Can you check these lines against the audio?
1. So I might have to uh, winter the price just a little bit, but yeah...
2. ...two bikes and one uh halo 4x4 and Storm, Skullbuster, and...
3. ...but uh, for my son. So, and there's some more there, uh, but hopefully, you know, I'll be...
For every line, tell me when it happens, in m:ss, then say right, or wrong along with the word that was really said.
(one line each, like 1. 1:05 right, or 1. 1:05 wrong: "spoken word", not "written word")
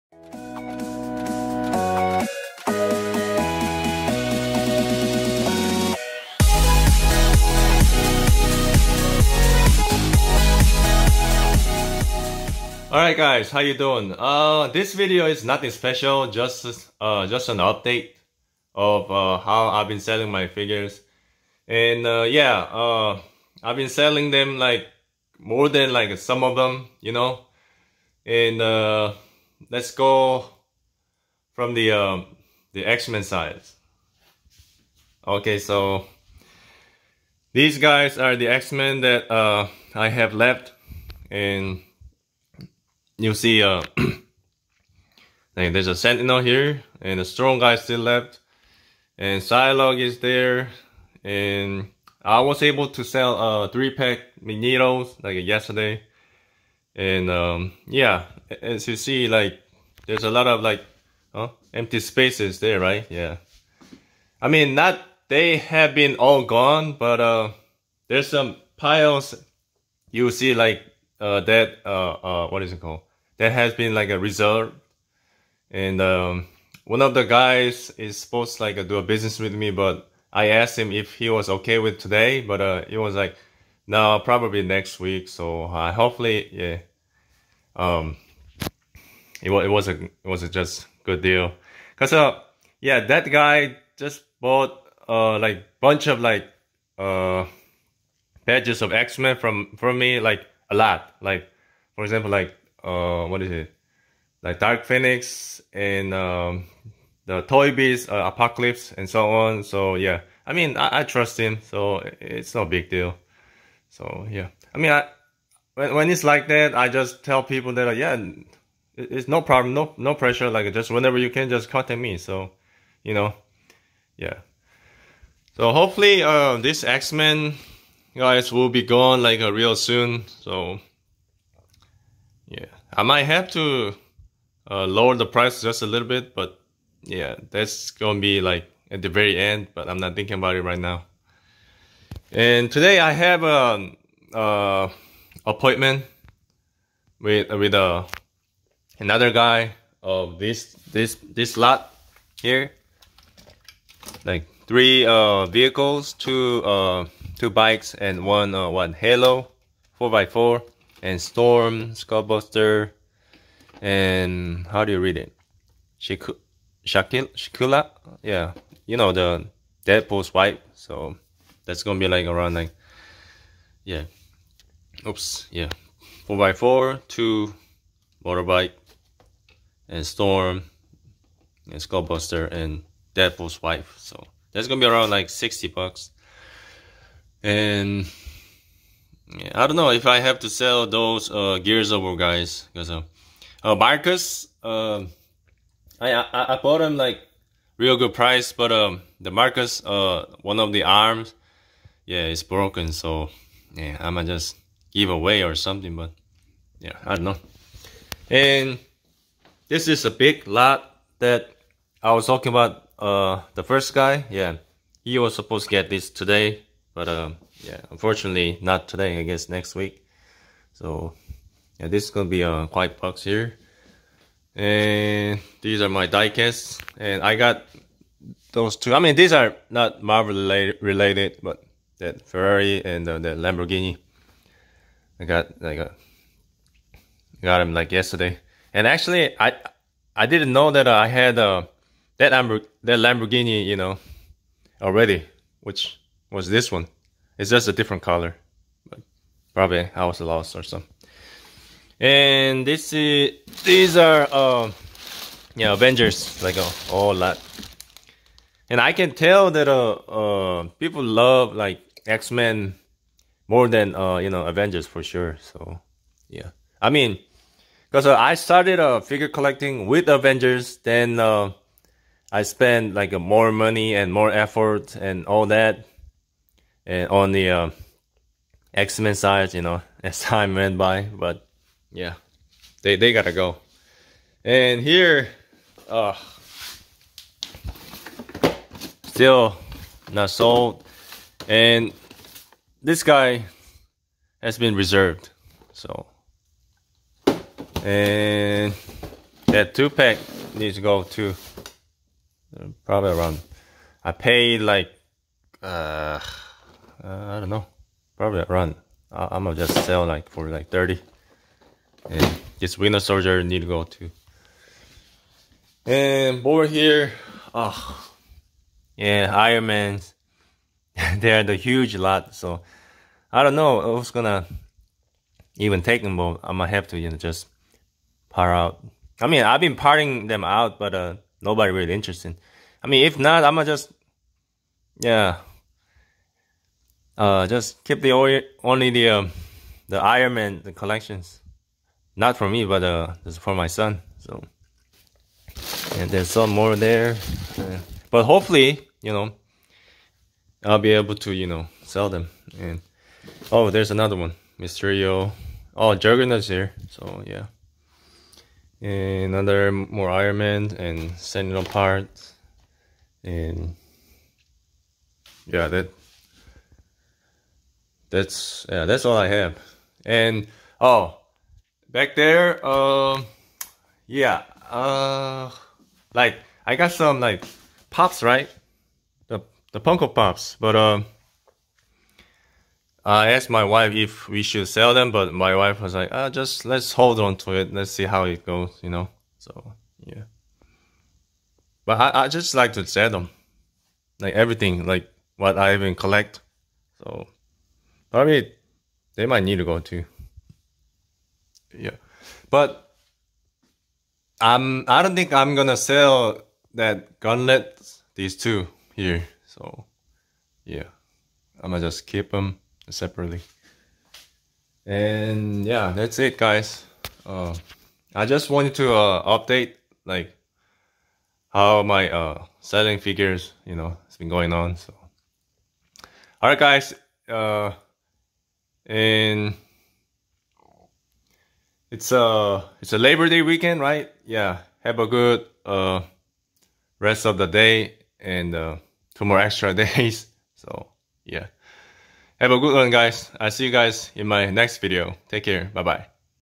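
1. 2:10 wrong: "lower", not "winter"
2. 2:37 right
3. 5:42 right.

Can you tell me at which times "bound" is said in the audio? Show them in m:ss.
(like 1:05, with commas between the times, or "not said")
not said.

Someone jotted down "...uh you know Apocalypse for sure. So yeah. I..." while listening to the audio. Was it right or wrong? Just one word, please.
wrong.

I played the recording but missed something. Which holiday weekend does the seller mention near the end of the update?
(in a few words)
Labor Day.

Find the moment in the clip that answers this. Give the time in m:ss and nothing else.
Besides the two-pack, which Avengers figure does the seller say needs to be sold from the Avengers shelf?
5:12.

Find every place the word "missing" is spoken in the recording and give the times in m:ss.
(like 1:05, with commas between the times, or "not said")
not said.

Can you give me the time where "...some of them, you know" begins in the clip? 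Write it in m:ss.
0:26.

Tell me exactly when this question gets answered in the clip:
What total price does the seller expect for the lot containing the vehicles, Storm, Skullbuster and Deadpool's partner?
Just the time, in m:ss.
3:05.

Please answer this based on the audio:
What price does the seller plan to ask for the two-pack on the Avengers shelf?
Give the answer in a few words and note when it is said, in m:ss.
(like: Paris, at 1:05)
$30, at 5:10.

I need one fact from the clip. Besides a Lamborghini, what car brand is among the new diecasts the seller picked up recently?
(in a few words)
Ferrari.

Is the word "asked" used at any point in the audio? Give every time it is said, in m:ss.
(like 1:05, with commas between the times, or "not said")
1:20, 6:23.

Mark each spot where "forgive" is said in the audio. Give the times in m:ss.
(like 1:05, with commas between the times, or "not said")
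not said.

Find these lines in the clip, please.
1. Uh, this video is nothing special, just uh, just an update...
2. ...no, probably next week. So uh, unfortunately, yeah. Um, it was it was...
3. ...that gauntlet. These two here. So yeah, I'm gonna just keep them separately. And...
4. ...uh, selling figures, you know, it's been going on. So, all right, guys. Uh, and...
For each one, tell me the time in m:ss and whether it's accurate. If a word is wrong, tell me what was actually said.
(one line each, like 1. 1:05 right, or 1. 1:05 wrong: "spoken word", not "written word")
1. 0:14 right
2. 1:23 wrong: "hopefully", not "unfortunately"
3. 6:46 right
4. 7:02 right.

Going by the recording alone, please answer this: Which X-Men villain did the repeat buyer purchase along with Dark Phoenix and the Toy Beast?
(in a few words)
Apocalypse.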